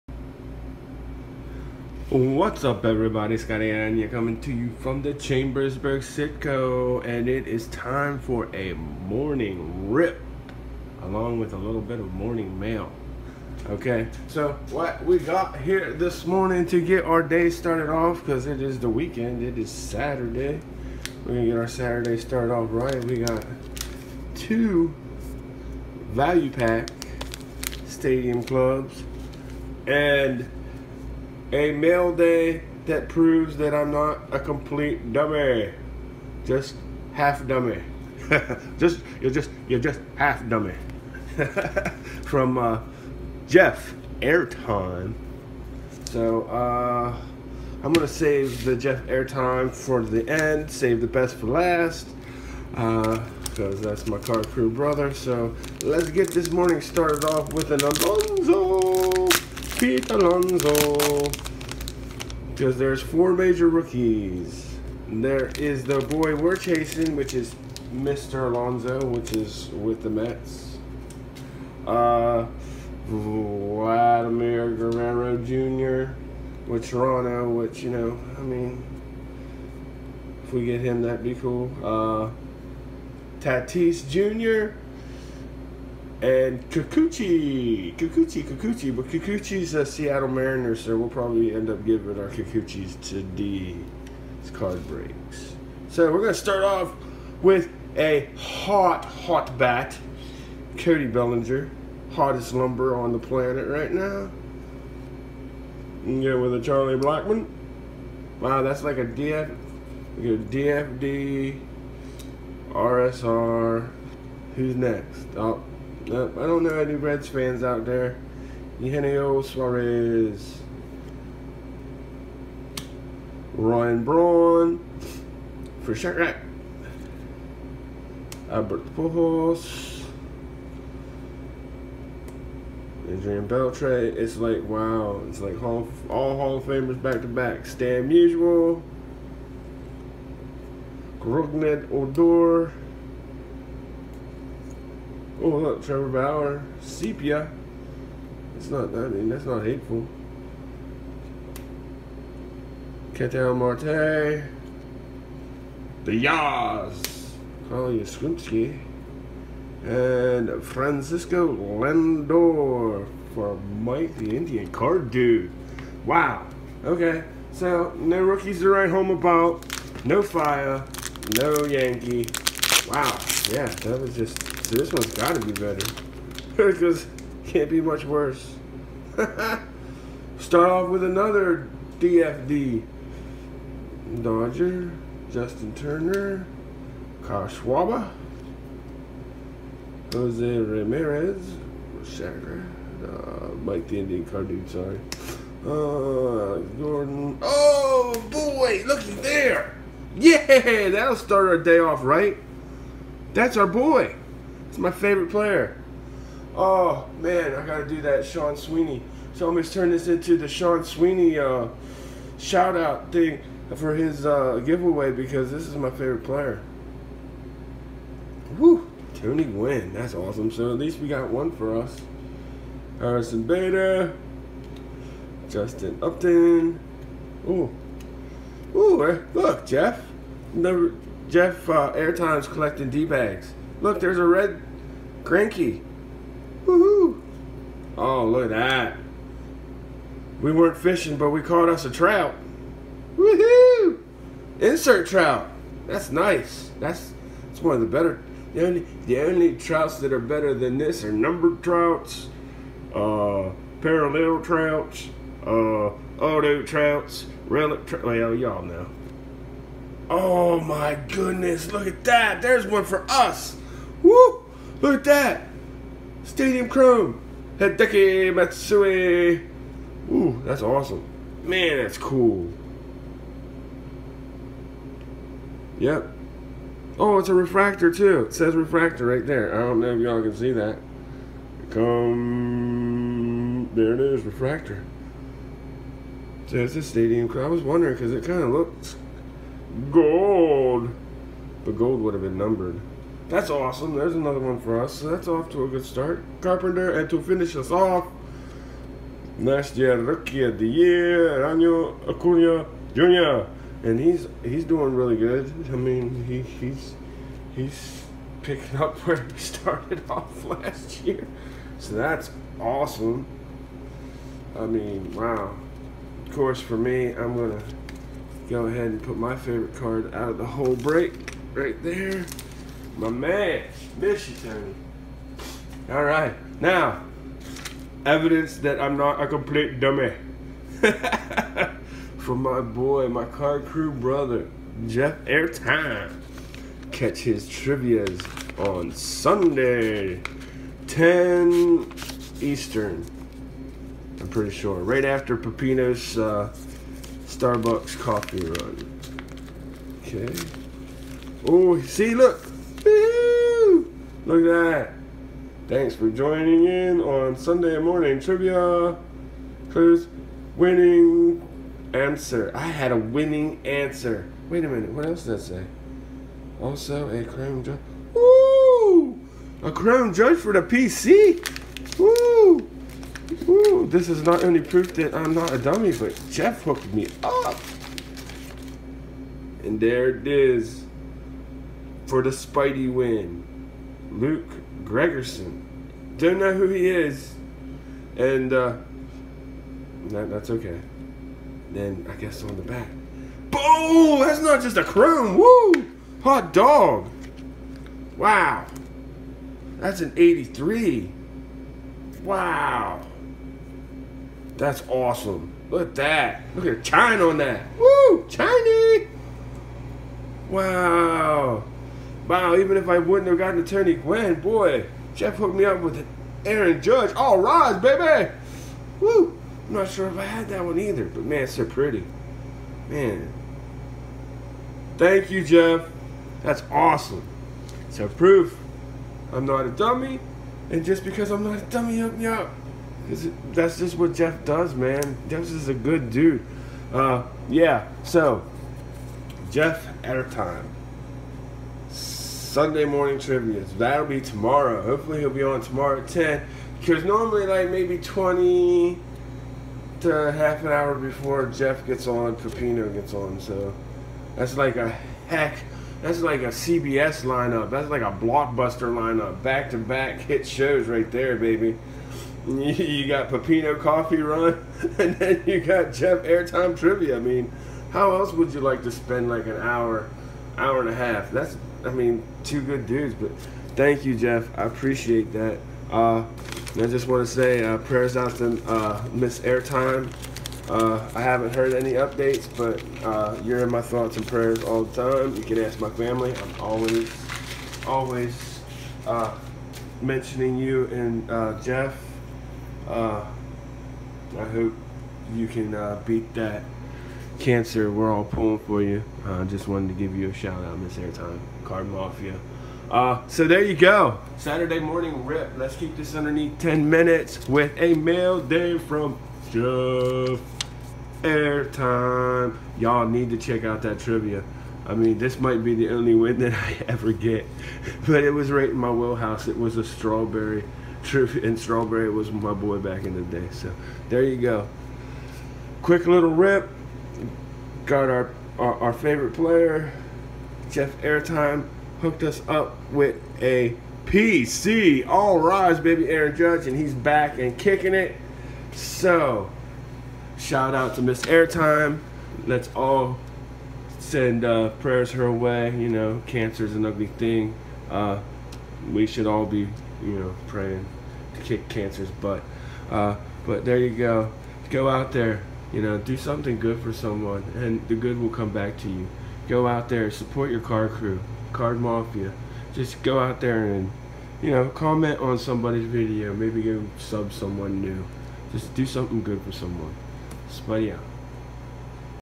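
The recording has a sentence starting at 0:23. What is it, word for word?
We got two value pack stadium clubs and a mail day that proves that I'm not a complete dummy.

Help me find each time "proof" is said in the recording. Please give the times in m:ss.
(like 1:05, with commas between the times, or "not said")
6:14, 7:08.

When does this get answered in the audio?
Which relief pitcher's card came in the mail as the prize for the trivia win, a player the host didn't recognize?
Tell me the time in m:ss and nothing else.
6:24.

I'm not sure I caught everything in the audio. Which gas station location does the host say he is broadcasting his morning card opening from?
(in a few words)
Chambersburg Sitco.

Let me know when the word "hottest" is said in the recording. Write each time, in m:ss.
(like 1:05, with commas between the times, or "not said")
1:42.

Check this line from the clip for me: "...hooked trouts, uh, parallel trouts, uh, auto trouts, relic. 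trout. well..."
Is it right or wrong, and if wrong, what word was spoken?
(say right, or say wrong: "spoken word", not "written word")
wrong: "numbered", not "hooked".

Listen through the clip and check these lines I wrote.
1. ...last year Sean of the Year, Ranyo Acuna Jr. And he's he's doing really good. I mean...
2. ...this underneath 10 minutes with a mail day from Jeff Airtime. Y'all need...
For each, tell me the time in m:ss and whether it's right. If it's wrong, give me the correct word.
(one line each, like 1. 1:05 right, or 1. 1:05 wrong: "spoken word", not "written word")
1. 4:59 wrong: "Rookie", not "Sean"
2. 8:25 right.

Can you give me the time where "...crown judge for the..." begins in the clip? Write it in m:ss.
6:09.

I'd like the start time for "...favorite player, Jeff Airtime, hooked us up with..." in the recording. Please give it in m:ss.
8:48.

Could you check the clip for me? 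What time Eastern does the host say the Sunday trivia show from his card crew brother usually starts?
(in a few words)
10 Eastern.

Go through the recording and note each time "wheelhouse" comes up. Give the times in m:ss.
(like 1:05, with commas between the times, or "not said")
8:38.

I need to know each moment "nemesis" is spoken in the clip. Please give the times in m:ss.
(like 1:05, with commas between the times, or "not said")
not said.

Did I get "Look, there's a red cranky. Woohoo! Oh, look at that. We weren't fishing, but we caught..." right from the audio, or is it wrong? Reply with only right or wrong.
right.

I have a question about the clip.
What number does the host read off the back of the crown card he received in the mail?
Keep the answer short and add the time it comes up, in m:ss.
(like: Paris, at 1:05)
83, at 6:40.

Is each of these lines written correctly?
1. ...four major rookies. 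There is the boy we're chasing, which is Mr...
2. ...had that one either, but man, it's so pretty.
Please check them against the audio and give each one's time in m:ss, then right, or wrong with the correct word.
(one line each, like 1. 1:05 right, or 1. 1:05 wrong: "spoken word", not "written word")
1. 1:03 right
2. 7:00 right.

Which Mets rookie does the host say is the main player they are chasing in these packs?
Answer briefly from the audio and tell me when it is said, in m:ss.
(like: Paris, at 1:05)
Pete Alonso, at 0:59.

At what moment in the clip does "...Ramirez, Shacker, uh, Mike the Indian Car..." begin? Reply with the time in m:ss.
3:10.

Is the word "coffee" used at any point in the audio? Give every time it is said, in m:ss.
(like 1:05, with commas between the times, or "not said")
5:47, 7:43.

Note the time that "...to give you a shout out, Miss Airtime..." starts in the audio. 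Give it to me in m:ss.
8:19.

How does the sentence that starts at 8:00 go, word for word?
Uh, I haven't heard any updates, but uh, you're in my thoughts and prayers all the time.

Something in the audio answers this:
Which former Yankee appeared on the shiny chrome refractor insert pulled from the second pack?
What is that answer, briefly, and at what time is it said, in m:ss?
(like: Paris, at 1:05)
Hideki Matsui, at 4:27.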